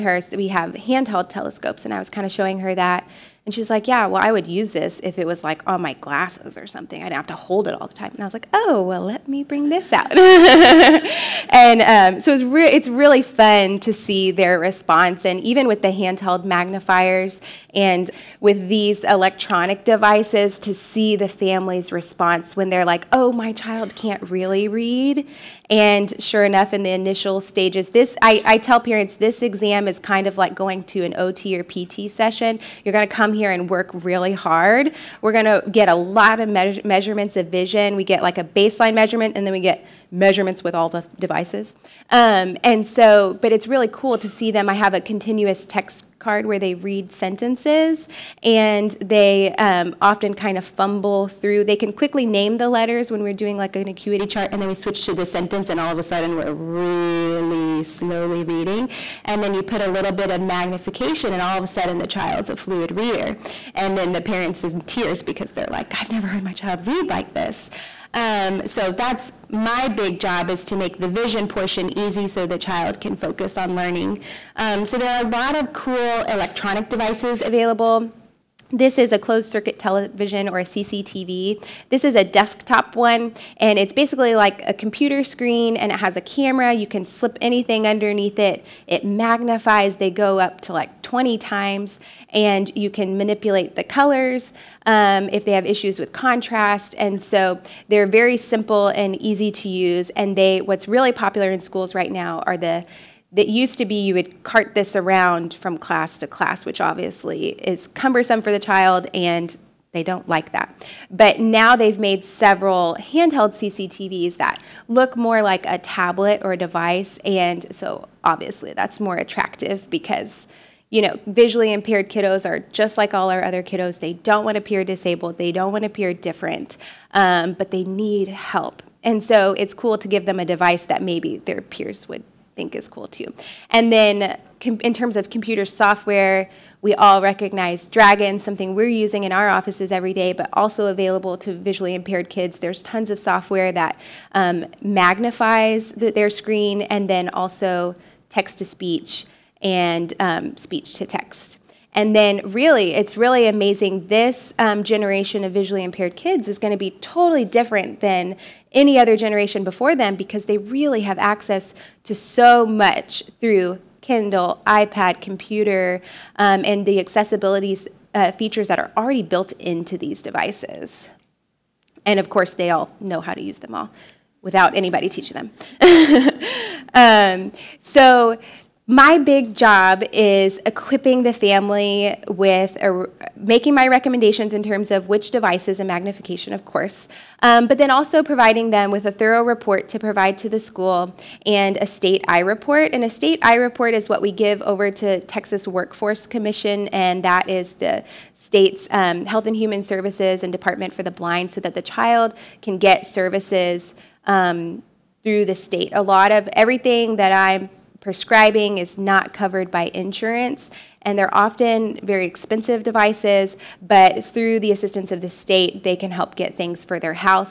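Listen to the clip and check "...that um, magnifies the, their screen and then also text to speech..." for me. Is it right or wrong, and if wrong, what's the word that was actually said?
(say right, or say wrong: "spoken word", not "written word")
right.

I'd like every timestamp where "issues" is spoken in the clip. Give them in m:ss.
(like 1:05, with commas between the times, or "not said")
1:35.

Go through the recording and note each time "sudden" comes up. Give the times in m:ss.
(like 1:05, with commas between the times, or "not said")
0:56, 1:01.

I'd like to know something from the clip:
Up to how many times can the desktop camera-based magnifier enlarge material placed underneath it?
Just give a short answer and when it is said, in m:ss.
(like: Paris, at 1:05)
20, at 1:31.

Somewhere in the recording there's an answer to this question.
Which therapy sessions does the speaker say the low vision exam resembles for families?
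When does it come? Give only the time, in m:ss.
0:31.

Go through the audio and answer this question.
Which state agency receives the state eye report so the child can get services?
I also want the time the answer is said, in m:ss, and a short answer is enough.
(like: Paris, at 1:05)
Texas Workforce Commission, at 3:15.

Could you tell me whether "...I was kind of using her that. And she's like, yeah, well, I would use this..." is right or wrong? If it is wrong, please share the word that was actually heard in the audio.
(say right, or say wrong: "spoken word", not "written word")
wrong: "showing", not "using".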